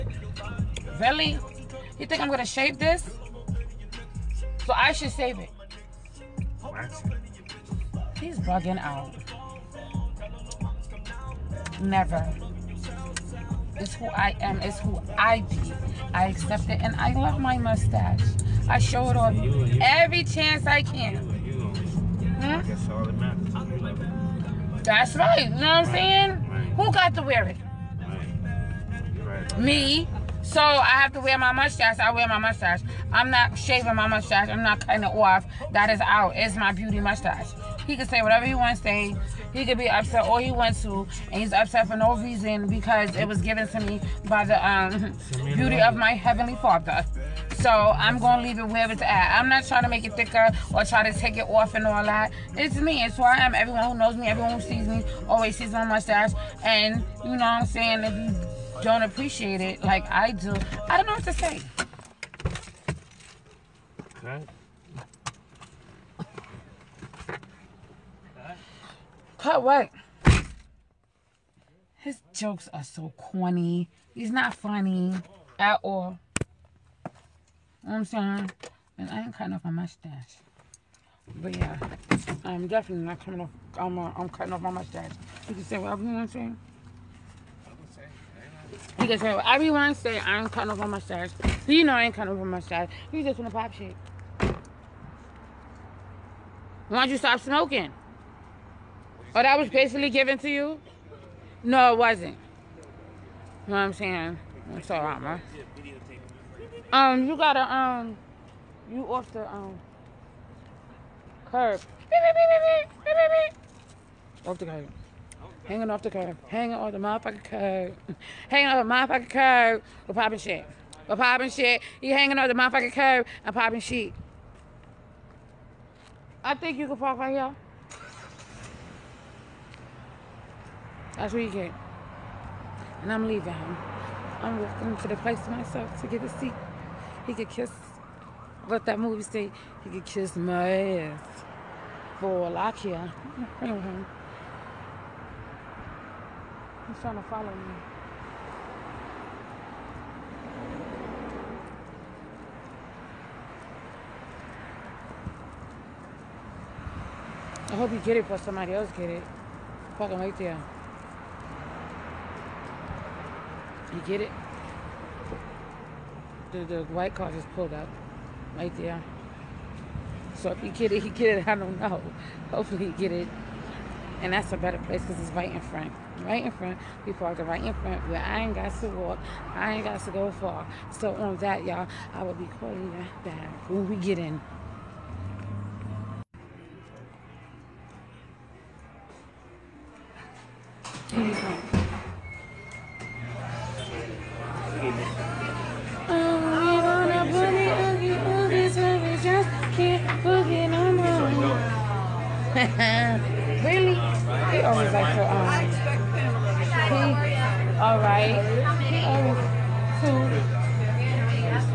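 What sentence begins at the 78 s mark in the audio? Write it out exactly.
And I ain't cutting off my mustache.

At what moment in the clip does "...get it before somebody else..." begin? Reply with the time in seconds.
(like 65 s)
157 s.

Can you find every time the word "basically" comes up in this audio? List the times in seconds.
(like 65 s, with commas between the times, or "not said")
99 s.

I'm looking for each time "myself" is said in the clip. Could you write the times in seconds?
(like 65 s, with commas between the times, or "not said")
135 s.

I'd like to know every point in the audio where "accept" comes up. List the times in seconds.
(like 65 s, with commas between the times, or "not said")
16 s.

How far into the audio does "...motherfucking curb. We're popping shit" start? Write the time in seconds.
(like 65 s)
118 s.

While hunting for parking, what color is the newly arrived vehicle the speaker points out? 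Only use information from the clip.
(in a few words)
white.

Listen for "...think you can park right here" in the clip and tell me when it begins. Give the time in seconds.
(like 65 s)
126 s.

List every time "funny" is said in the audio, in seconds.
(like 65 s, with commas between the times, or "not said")
74 s.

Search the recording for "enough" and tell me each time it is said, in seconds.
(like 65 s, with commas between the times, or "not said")
not said.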